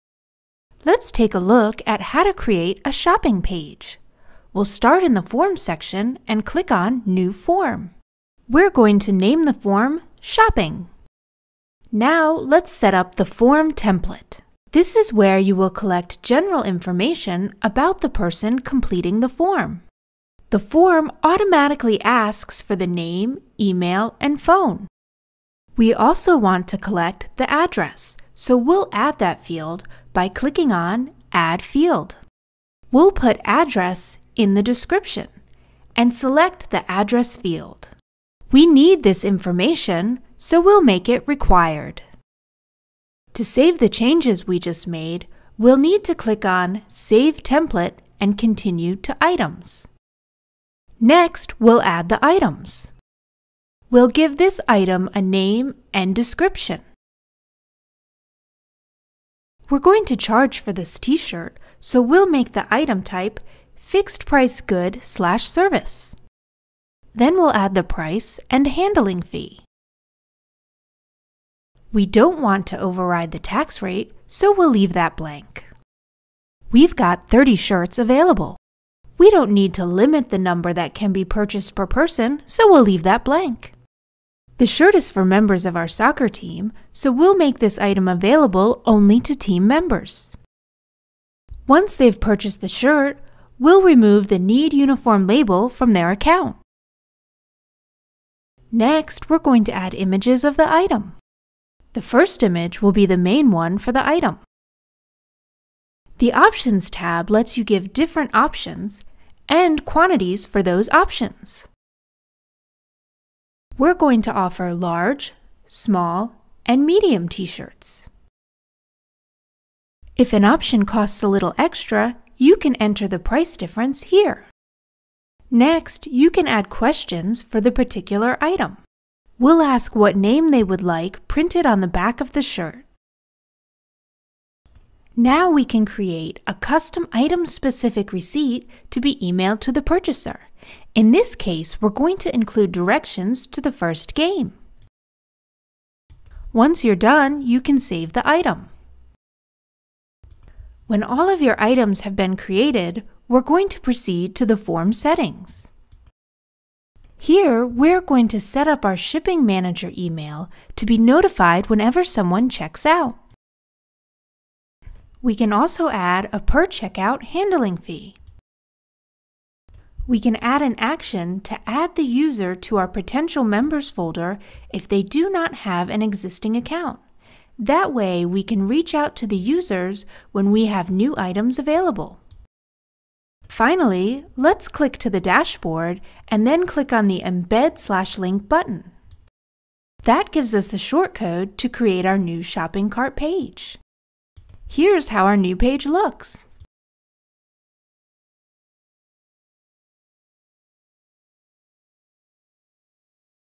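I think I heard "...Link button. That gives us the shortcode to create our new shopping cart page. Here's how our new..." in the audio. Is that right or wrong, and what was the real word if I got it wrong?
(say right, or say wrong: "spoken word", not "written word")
right.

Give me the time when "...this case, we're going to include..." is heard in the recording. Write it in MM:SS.
02:21.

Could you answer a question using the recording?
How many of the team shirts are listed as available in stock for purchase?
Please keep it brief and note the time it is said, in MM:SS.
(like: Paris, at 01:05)
30, at 01:17.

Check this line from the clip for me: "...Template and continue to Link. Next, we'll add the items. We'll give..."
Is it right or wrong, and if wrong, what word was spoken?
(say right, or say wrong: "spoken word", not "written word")
wrong: "Items", not "Link".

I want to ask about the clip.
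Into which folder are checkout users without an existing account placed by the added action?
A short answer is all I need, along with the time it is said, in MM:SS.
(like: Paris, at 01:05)
potential members, at 02:52.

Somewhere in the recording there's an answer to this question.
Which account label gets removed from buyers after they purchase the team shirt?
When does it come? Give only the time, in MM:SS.
01:34.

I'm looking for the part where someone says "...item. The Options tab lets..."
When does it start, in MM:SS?
01:44.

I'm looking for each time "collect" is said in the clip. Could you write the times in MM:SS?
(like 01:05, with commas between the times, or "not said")
00:15, 00:26.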